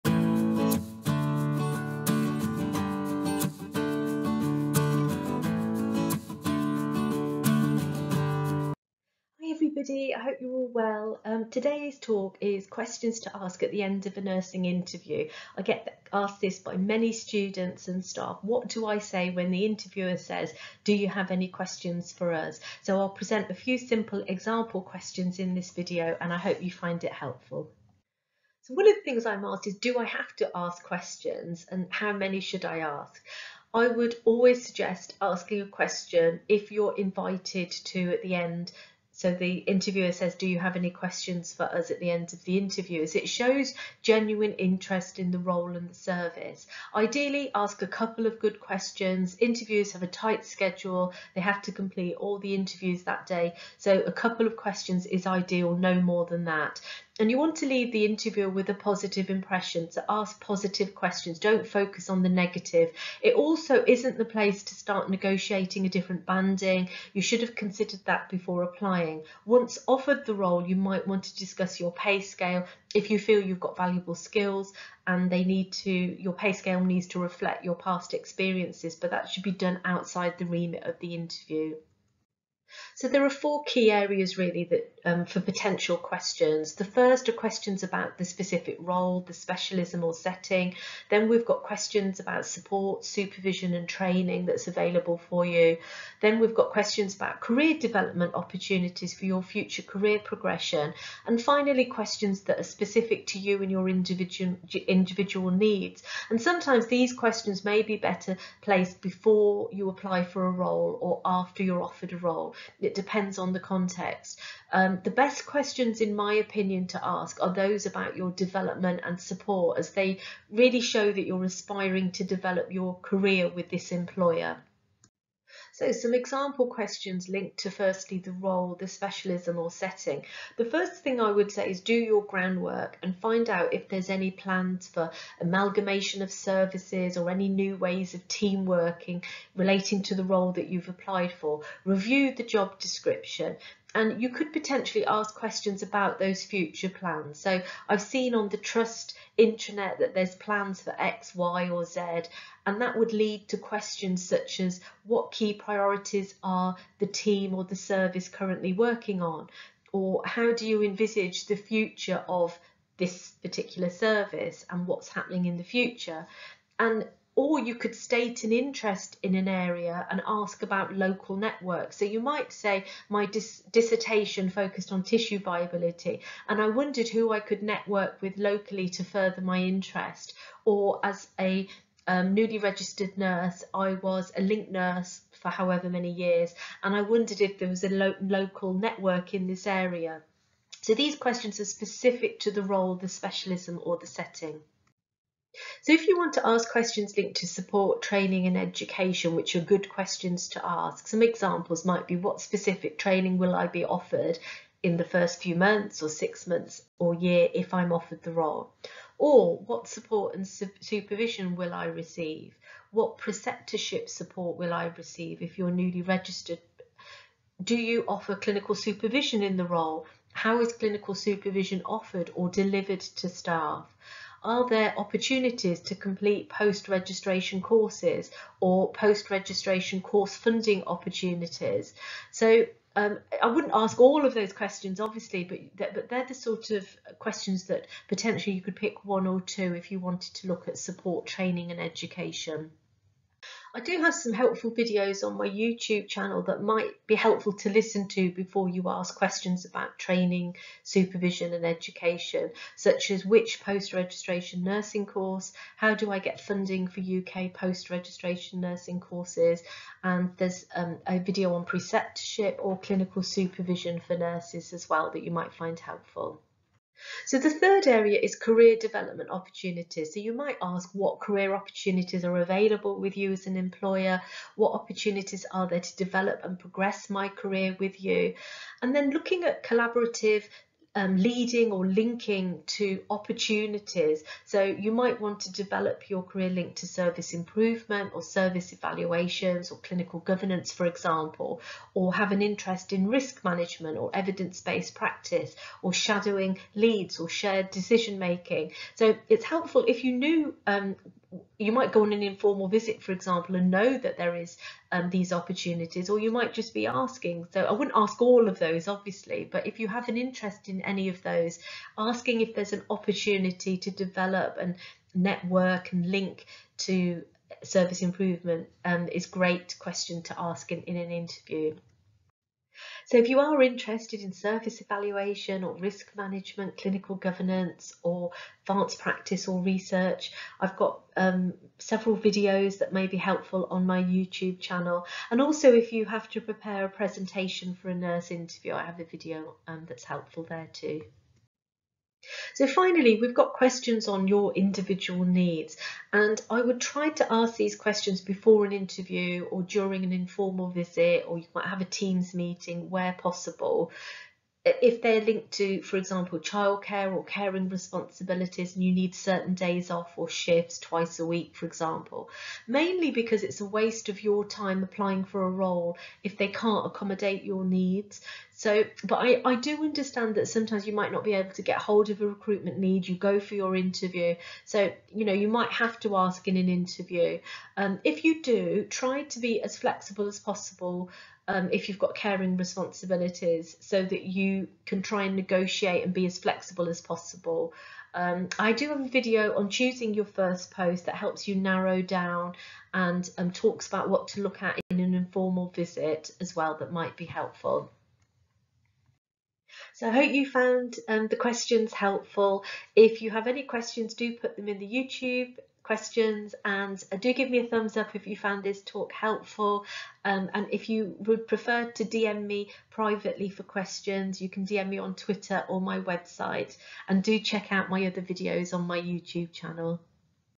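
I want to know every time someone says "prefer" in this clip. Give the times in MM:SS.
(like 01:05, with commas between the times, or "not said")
06:51.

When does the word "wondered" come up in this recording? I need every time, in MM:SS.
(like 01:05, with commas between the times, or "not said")
02:56, 03:07.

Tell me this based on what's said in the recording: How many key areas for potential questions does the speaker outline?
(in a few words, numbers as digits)
4.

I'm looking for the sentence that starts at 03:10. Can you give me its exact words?
So these questions are specific to the role, the specialism or the setting.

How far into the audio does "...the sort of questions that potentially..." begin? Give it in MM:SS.
03:56.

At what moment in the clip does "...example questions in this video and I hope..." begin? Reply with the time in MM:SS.
00:24.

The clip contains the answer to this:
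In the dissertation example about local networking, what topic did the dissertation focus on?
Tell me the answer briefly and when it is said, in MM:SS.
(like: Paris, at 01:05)
Tissue viability, at 02:55.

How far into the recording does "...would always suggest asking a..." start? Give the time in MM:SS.
00:33.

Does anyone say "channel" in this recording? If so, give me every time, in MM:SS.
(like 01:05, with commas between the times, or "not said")
04:06, 05:34, 06:59.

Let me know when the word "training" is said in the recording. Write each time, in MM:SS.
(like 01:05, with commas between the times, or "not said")
01:33, 03:18, 03:22, 04:01, 04:09.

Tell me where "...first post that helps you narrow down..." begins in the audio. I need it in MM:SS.
06:30.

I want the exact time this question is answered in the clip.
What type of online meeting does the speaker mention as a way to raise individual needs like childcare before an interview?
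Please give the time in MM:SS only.
05:51.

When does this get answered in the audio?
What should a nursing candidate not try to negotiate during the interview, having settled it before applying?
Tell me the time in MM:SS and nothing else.
01:05.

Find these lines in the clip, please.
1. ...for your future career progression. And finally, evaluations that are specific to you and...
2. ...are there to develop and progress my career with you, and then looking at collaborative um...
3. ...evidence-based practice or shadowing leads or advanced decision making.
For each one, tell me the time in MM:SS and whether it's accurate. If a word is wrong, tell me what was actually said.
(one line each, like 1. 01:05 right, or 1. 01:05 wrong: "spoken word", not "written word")
1. 01:39 wrong: "questions", not "evaluations"
2. 04:35 right
3. 04:54 wrong: "shared", not "advanced".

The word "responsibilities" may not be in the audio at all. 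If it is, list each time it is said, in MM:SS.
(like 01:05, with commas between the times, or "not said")
05:57, 06:22.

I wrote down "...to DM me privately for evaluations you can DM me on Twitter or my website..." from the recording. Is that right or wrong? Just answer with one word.
wrong.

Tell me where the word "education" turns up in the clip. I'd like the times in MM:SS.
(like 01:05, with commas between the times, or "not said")
03:18, 04:01, 04:11.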